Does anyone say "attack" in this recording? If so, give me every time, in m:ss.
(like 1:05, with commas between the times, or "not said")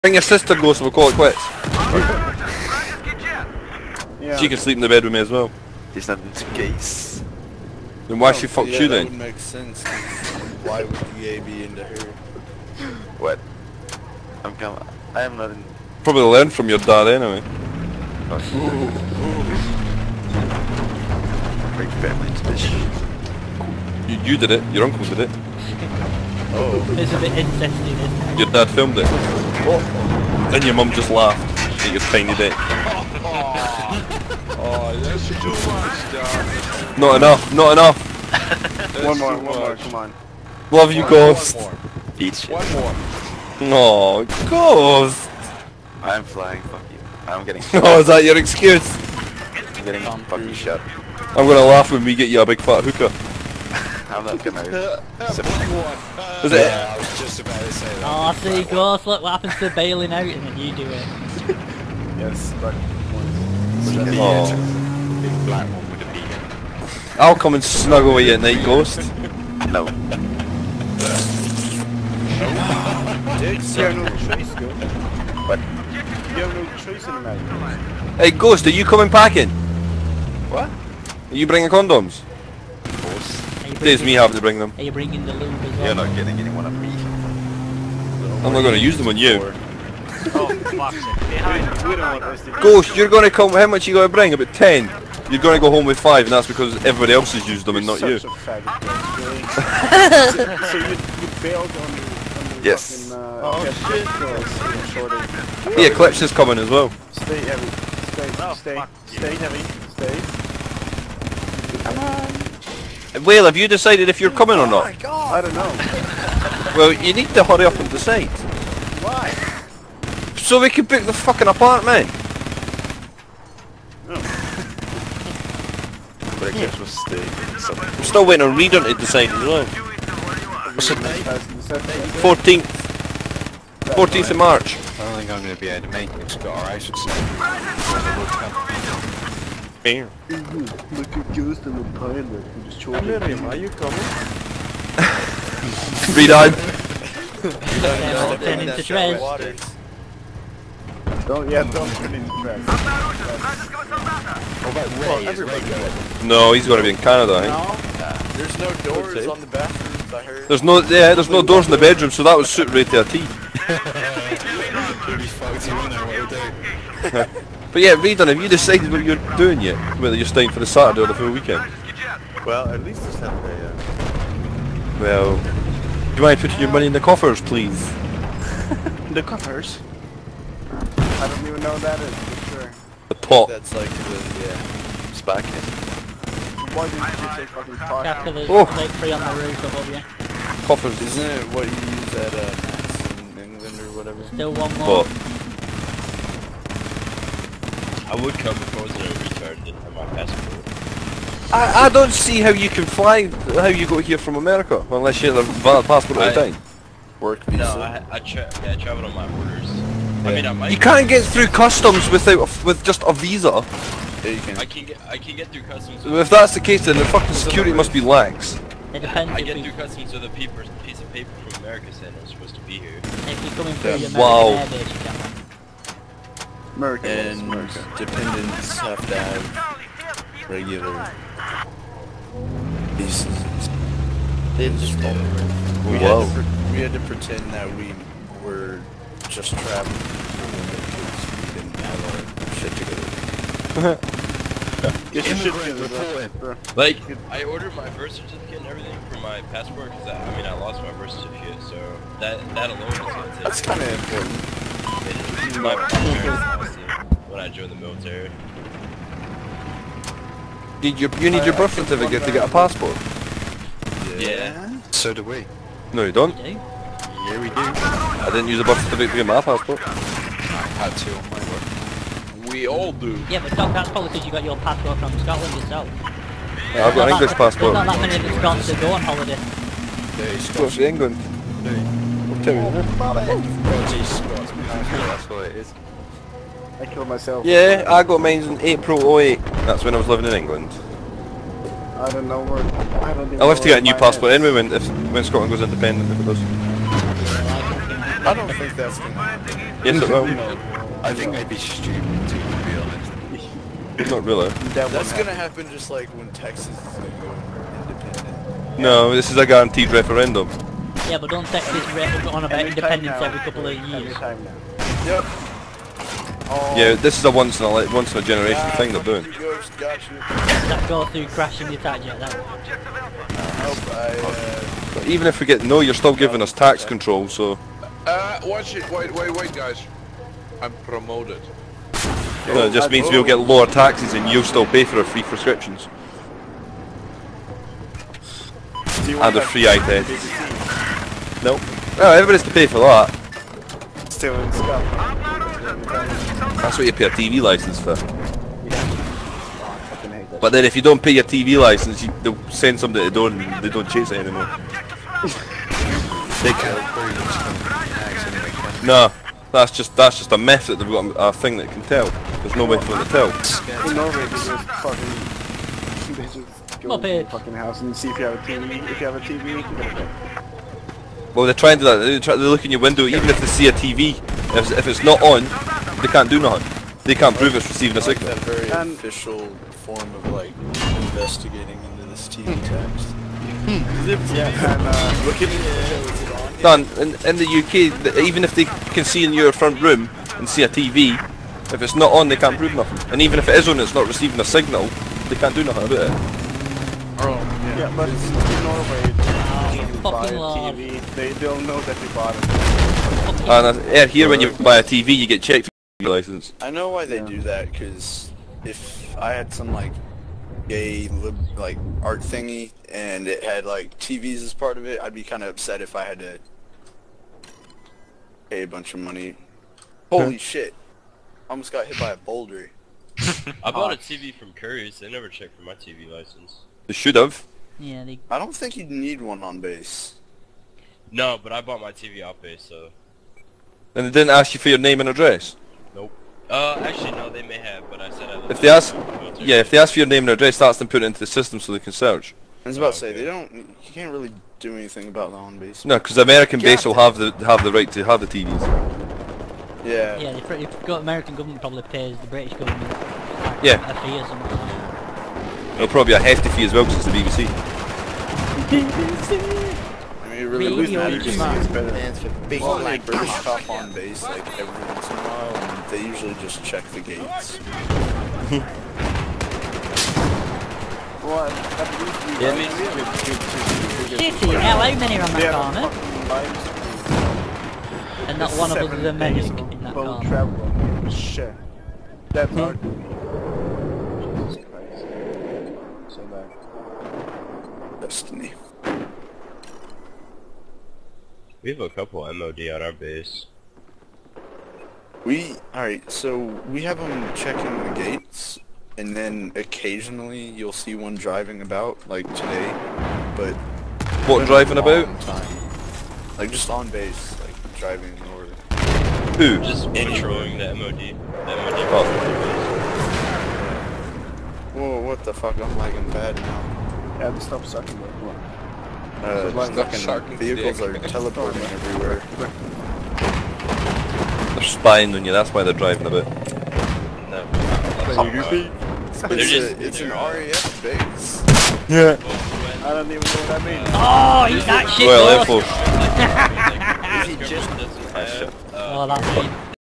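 5:21.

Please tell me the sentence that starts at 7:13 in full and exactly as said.
And they didn't ask you for your name and address?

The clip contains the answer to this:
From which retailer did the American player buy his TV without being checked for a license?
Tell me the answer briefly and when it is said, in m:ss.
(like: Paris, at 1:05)
Curry's, at 7:04.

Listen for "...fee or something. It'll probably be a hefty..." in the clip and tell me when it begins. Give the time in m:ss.
7:34.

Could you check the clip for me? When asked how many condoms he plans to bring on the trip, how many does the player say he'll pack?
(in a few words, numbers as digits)
10.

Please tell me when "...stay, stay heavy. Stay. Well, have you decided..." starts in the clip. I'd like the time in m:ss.
1:48.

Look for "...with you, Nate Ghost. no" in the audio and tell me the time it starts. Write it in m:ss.
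1:08.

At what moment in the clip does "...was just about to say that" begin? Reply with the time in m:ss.
0:56.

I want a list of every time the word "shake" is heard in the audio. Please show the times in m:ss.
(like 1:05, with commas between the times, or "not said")
not said.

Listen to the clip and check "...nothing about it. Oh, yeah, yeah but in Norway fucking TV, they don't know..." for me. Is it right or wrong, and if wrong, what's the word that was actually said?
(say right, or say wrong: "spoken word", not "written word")
right.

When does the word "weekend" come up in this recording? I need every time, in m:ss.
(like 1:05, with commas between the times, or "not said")
2:51.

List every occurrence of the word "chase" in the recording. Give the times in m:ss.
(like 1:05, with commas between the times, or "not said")
5:53.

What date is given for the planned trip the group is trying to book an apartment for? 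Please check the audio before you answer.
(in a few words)
14th of March.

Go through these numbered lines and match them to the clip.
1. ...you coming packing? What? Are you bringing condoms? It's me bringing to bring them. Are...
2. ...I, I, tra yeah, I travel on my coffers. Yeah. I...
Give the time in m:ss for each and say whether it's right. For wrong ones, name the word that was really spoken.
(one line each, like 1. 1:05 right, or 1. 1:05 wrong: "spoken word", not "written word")
1. 1:18 wrong: "having", not "bringing"
2. 3:27 wrong: "orders", not "coffers".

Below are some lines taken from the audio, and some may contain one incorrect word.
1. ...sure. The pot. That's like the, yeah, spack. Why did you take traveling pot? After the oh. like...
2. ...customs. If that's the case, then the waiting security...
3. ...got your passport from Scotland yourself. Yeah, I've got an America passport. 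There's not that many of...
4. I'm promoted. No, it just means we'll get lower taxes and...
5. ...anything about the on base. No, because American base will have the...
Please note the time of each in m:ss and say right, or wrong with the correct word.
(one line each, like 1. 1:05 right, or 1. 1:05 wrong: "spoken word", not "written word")
1. 3:02 wrong: "fucking", not "traveling"
2. 3:35 wrong: "fucking", not "waiting"
3. 4:34 wrong: "English", not "America"
4. 5:30 right
5. 7:24 right.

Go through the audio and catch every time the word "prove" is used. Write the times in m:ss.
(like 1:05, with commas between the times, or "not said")
6:17, 6:32.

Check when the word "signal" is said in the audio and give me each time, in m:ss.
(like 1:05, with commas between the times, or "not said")
6:18, 6:34.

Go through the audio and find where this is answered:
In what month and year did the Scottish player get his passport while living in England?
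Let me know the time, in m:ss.
4:48.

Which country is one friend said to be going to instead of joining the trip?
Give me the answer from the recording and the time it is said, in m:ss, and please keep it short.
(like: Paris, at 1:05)
Canada, at 2:36.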